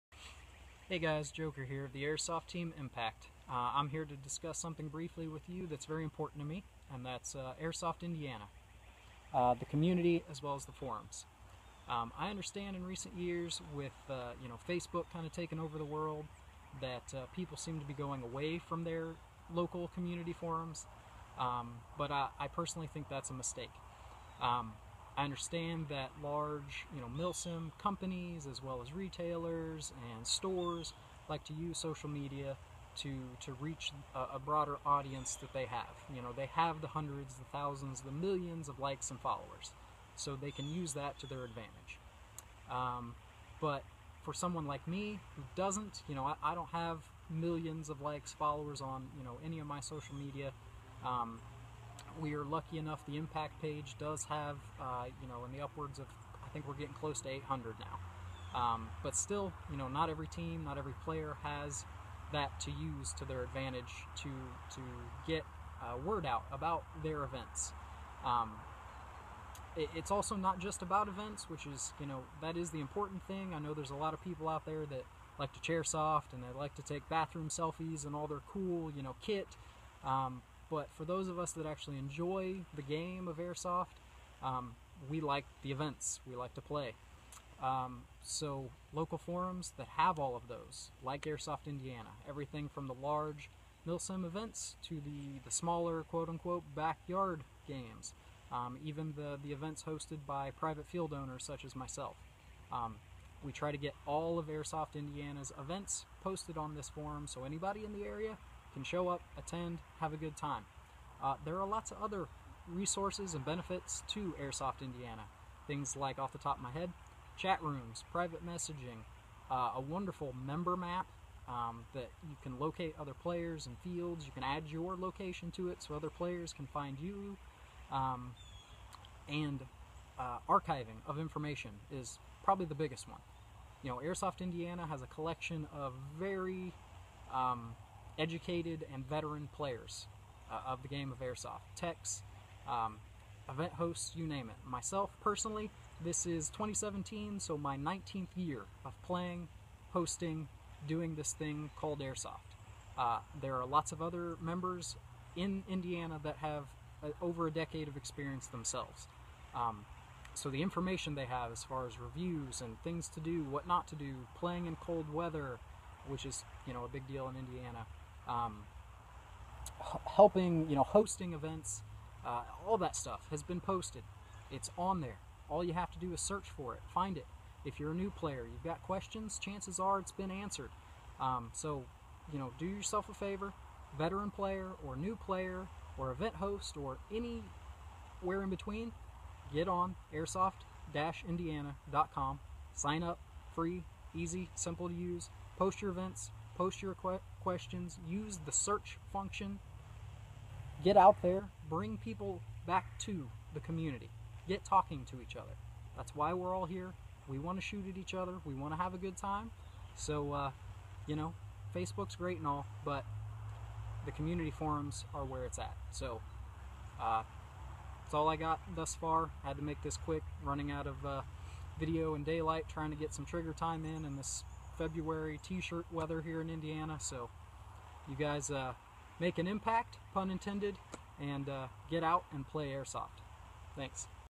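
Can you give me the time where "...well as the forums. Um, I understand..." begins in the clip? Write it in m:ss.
0:10.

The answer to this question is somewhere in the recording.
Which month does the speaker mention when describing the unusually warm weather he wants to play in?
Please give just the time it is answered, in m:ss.
3:44.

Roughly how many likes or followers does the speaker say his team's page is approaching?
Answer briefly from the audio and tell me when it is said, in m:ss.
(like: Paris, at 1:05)
800, at 0:57.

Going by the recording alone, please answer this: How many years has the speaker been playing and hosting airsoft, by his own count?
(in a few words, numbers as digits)
19.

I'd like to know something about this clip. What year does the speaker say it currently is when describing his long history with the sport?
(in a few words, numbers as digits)
2017.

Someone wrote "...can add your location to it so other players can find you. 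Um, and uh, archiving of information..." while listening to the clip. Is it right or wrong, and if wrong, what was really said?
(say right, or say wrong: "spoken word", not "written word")
right.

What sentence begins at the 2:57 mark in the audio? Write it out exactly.
If you're a new player, you've got questions, chances are it's been answered.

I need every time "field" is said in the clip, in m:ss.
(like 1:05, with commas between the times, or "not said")
1:40, 2:03.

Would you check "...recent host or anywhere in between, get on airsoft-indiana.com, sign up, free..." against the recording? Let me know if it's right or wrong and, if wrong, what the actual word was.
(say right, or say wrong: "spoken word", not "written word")
wrong: "event", not "recent".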